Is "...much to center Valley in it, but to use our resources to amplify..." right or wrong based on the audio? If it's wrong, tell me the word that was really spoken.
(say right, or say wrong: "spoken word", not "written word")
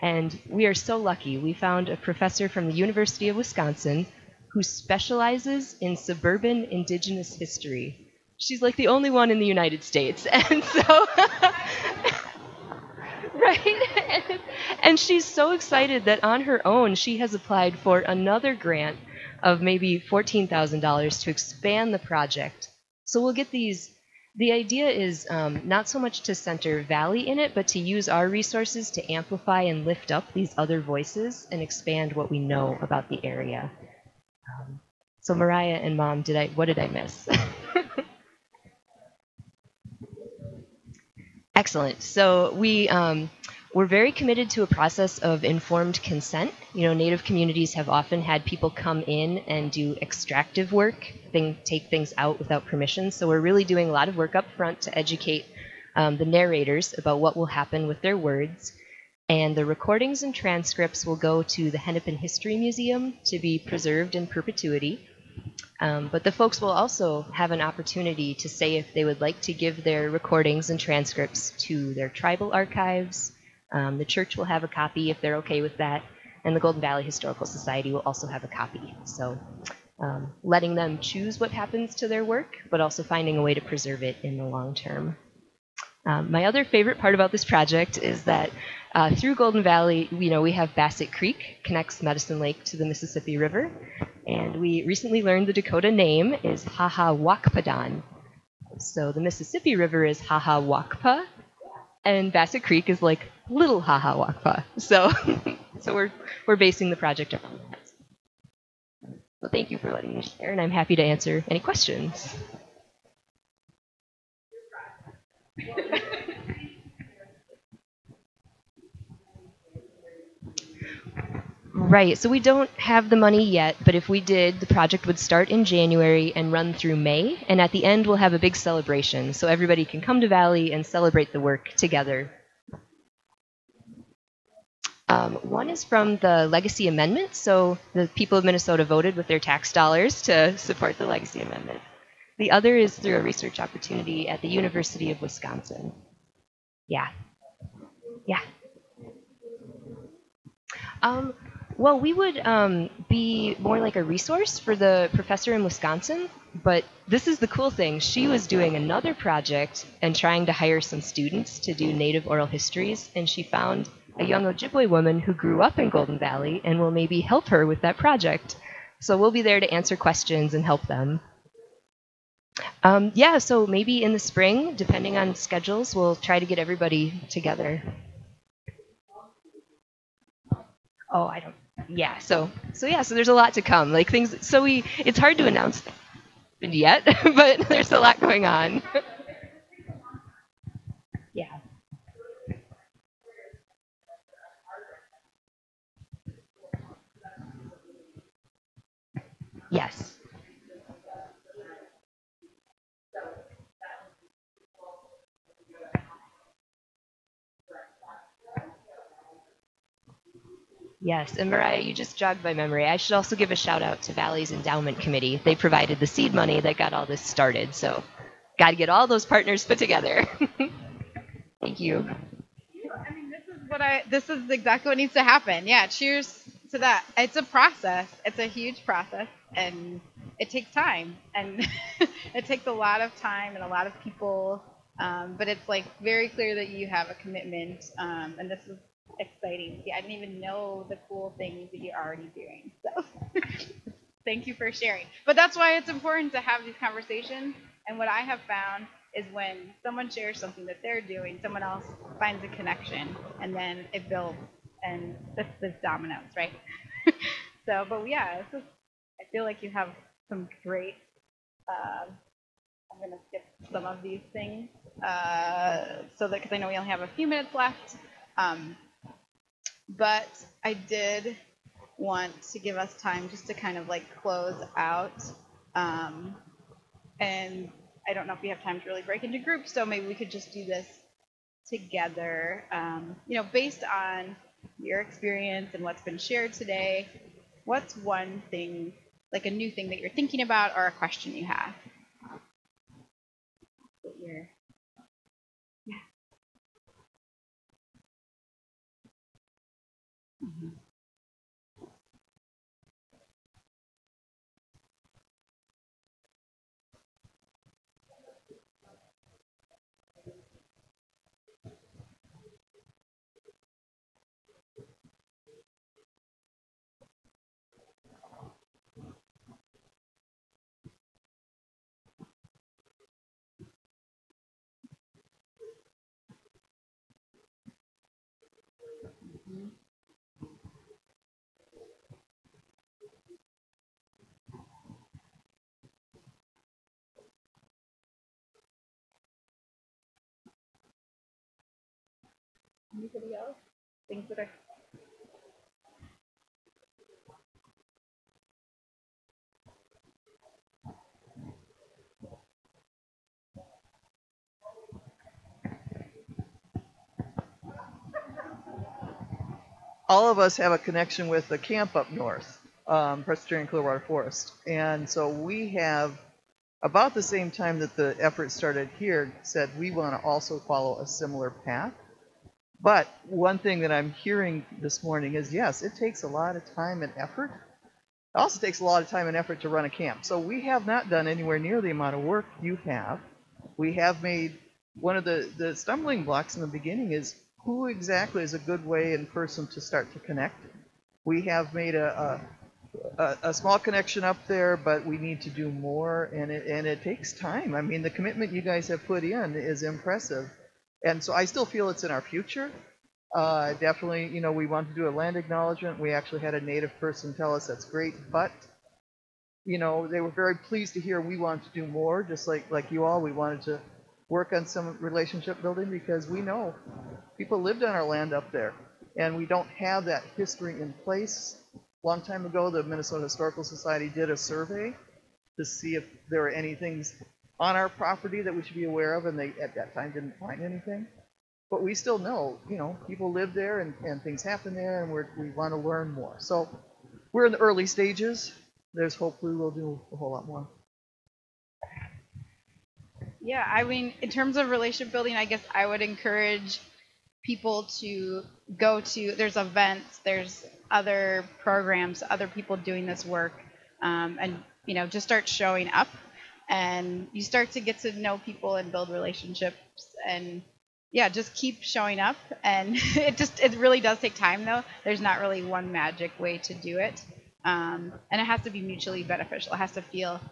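right.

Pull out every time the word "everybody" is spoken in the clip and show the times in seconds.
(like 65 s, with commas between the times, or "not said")
129 s, 176 s.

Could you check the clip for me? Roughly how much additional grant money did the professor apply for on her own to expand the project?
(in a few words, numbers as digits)
$14,000.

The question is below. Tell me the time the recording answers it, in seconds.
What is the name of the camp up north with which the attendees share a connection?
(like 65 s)
363 s.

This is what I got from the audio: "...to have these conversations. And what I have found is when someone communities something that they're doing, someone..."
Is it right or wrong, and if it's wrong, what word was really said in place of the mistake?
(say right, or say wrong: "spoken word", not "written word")
wrong: "shares", not "communities".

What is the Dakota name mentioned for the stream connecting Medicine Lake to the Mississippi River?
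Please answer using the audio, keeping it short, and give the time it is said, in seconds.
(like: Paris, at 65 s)
Wakpadan, at 96 s.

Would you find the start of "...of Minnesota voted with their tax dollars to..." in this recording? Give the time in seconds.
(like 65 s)
138 s.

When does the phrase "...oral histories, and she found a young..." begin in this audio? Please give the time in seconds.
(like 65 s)
162 s.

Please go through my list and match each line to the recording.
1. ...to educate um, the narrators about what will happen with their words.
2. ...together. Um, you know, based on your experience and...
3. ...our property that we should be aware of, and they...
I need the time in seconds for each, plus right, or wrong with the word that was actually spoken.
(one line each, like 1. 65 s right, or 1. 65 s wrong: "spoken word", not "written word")
1. 54 s right
2. 281 s right
3. 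427 s right.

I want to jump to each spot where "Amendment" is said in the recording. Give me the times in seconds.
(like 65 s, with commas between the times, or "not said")
136 s, 141 s.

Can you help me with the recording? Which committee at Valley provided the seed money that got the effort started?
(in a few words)
Endowment Committee.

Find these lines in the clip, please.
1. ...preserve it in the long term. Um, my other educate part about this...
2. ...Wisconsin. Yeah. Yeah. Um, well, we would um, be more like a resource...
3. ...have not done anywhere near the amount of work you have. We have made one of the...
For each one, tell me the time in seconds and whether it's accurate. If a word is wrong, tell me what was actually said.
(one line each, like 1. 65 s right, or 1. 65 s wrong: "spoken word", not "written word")
1. 83 s wrong: "favorite", not "educate"
2. 145 s right
3. 380 s right.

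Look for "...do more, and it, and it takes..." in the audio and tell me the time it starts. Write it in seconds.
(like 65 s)
395 s.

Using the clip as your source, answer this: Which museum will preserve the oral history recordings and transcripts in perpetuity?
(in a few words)
Hennepin History Museum.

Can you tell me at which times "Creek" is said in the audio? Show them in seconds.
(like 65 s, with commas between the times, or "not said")
91 s, 102 s.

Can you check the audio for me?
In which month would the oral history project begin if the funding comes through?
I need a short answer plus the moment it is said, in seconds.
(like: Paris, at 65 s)
January, at 125 s.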